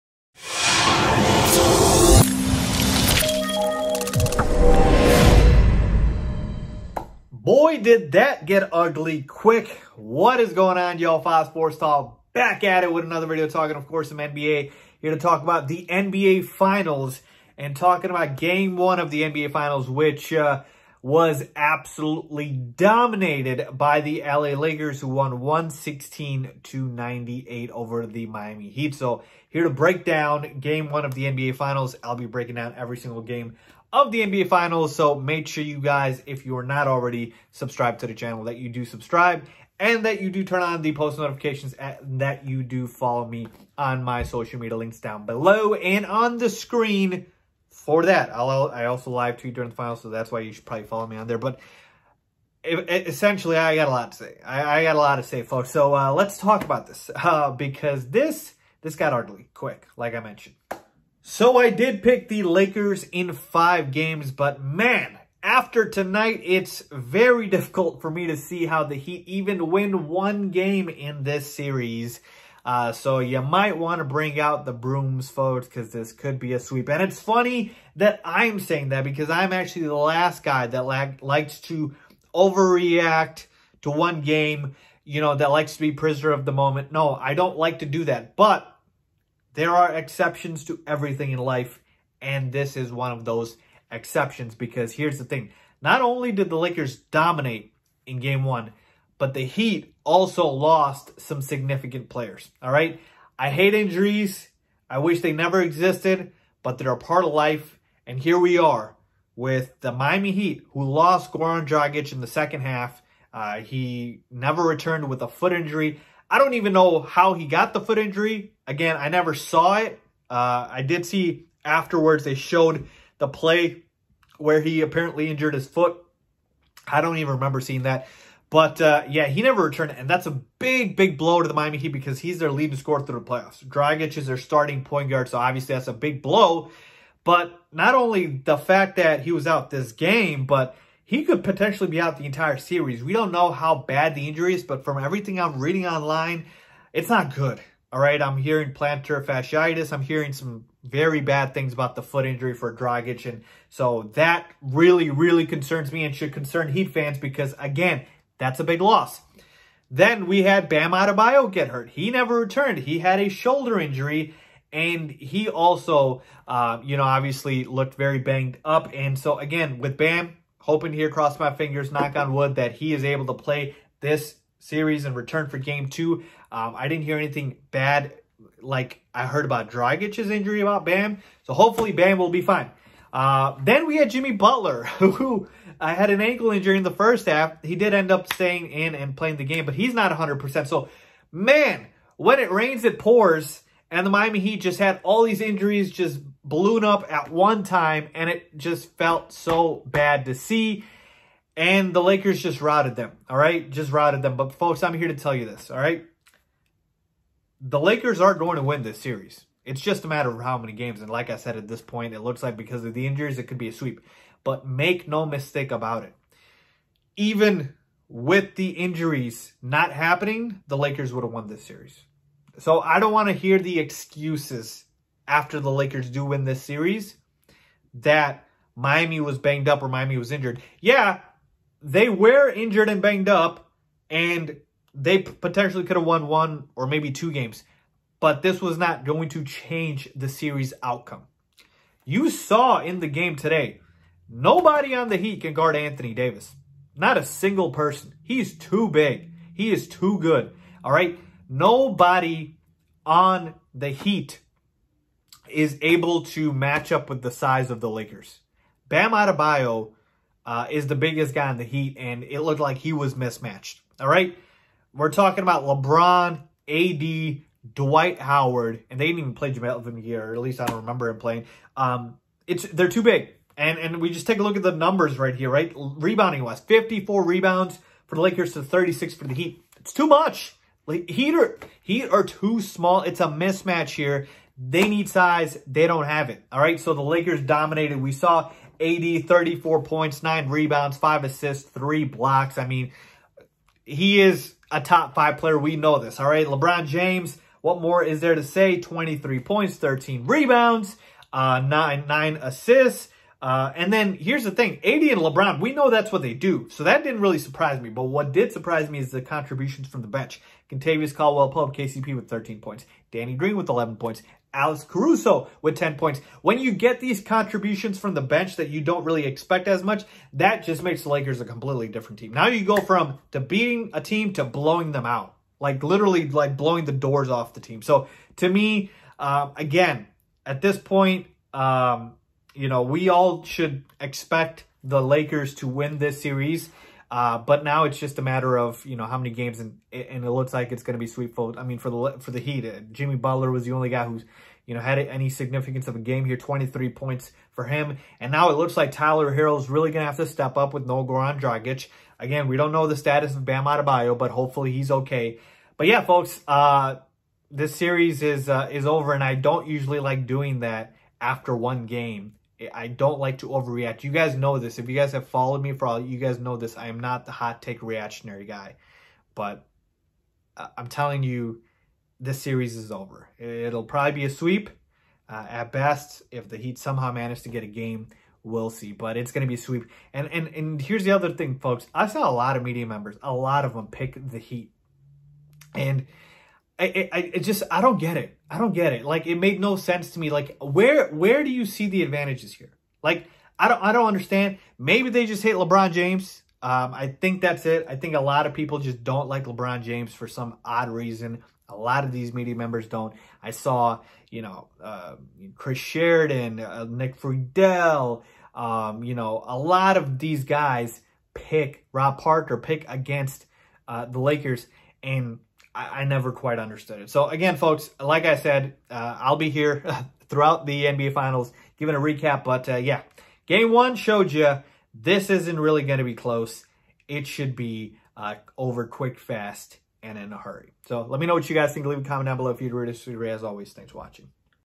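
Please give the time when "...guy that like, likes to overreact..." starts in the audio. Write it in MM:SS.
01:20.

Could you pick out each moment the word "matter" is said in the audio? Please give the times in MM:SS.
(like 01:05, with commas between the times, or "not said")
03:30, 05:38.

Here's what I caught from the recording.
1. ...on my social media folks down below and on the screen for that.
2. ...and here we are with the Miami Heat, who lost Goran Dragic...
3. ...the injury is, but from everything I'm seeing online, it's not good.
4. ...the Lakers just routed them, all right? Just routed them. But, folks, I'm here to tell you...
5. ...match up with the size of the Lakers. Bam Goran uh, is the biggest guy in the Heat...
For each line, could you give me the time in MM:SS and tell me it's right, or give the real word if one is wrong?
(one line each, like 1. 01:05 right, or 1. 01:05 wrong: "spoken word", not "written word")
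1. 00:43 wrong: "links", not "folks"
2. 01:48 right
3. 02:24 wrong: "reading", not "seeing"
4. 03:21 right
5. 04:16 wrong: "Adebayo", not "Goran".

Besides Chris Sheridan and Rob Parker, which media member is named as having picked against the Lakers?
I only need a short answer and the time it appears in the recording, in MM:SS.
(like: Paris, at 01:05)
Nick Friedell, at 06:46.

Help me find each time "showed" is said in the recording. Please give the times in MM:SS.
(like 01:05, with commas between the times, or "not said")
02:02, 07:03.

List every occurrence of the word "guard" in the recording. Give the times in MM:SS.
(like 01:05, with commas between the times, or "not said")
02:15, 04:05.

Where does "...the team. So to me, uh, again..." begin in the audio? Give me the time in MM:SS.
05:27.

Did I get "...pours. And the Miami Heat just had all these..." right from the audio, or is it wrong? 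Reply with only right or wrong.
right.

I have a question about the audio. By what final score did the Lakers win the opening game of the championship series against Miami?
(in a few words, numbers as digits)
116 to 98.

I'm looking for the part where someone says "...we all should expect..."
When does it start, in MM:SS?
05:32.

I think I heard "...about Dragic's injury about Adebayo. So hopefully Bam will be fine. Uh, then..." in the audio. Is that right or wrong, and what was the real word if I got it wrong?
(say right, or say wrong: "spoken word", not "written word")
wrong: "Bam", not "Adebayo".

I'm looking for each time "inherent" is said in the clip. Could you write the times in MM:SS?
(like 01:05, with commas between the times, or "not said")
not said.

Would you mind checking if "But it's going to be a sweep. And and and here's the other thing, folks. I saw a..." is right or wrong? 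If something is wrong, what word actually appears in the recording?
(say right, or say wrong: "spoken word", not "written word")
right.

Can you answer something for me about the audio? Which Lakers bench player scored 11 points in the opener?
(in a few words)
Danny Green.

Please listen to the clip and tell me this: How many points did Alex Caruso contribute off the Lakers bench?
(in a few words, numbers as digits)
10.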